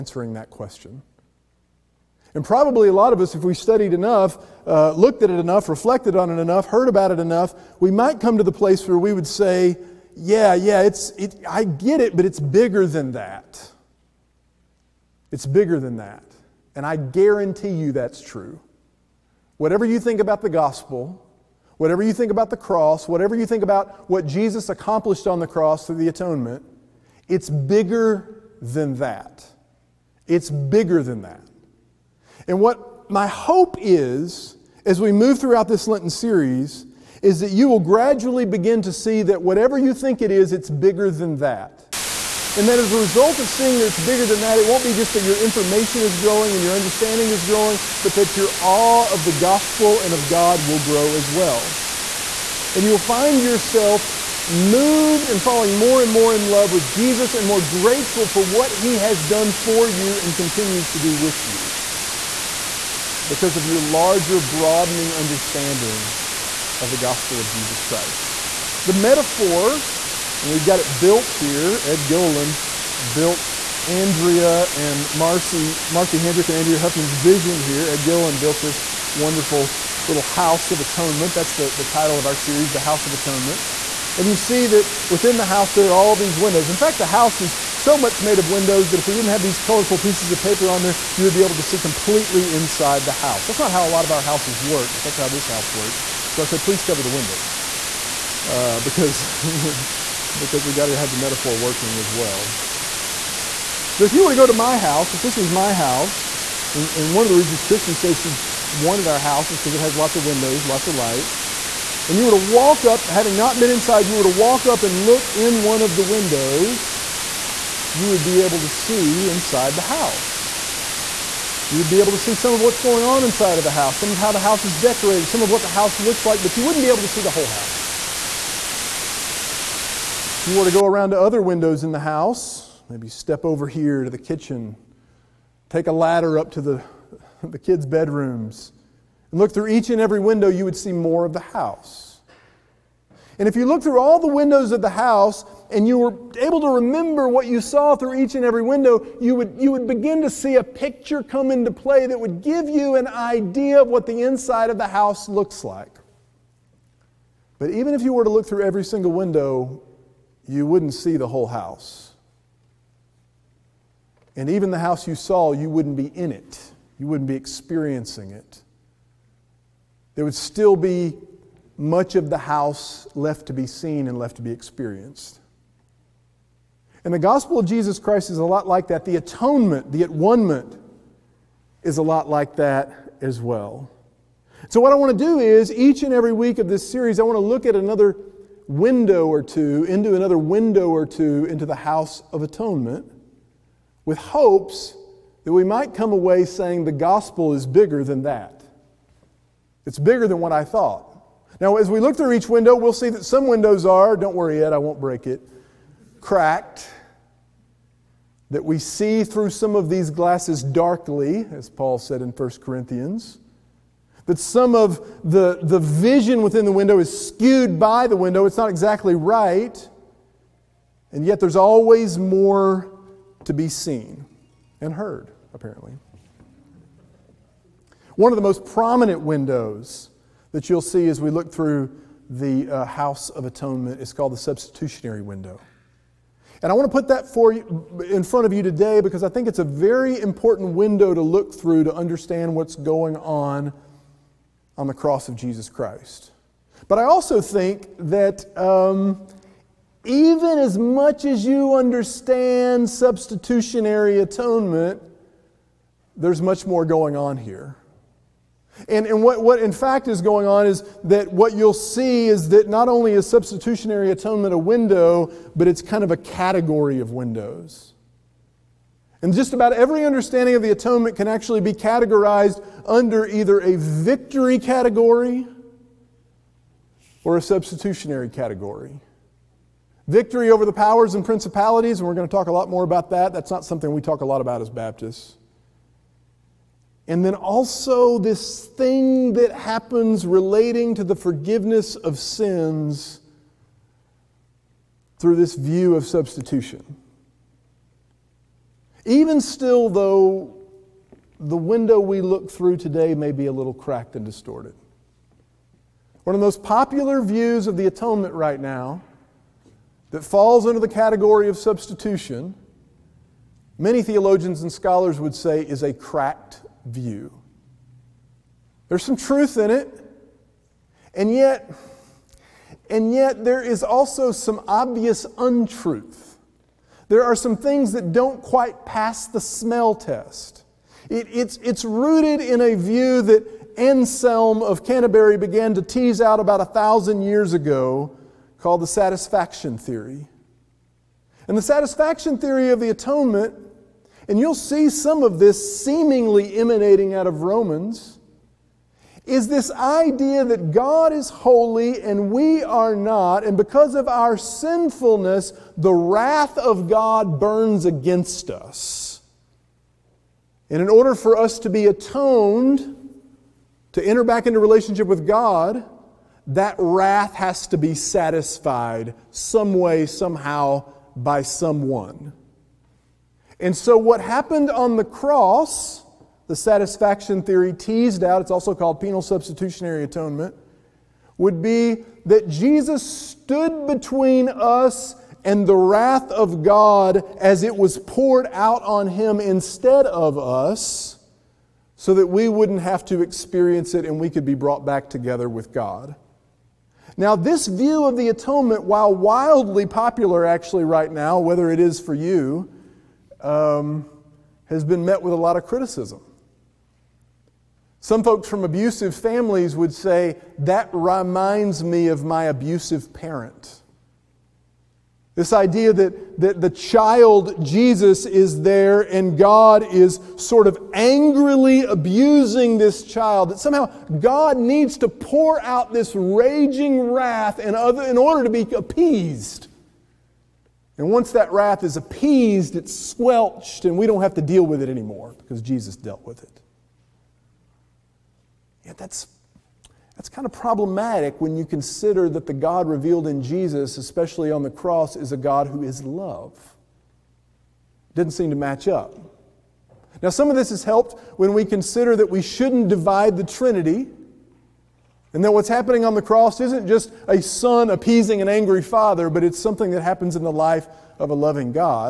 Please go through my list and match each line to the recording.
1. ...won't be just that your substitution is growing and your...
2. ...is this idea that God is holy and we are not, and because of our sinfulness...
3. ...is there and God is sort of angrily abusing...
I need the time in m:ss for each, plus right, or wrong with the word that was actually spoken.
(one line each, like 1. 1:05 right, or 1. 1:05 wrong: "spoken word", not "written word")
1. 0:44 wrong: "information", not "substitution"
2. 5:49 right
3. 6:58 right.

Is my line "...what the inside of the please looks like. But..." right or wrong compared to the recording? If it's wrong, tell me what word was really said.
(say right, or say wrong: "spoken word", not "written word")
wrong: "house", not "please".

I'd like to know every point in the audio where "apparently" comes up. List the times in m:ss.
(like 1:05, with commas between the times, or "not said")
3:45.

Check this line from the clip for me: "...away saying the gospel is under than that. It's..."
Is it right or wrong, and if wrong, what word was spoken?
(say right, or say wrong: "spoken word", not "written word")
wrong: "bigger", not "under".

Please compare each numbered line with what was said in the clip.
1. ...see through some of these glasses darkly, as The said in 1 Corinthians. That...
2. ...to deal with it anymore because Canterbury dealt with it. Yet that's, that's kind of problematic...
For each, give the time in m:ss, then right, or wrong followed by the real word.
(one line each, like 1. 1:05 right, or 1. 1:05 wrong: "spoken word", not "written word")
1. 3:28 wrong: "Paul", not "The"
2. 7:14 wrong: "Jesus", not "Canterbury".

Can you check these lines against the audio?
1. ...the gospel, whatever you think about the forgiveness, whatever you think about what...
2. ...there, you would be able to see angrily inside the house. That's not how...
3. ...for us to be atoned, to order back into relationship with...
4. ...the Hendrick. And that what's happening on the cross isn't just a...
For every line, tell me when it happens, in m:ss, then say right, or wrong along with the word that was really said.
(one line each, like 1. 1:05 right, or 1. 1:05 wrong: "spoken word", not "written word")
1. 0:20 wrong: "cross", not "forgiveness"
2. 1:30 wrong: "completely", not "angrily"
3. 6:01 wrong: "enter", not "order"
4. 7:33 wrong: "Trinity", not "Hendrick".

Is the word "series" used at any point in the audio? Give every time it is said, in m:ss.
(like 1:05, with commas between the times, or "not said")
0:36, 1:22, 3:06.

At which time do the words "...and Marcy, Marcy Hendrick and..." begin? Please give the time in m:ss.
1:14.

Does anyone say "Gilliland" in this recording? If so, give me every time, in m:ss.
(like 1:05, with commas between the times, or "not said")
1:12, 1:18.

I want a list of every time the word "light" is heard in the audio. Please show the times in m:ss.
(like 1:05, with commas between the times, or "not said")
1:50.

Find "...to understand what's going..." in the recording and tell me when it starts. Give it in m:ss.
4:01.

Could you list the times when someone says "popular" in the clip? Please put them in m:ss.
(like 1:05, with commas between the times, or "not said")
5:06, 6:39.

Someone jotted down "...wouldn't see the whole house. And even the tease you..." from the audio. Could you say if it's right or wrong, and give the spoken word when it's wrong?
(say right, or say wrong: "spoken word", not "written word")
wrong: "house", not "tease".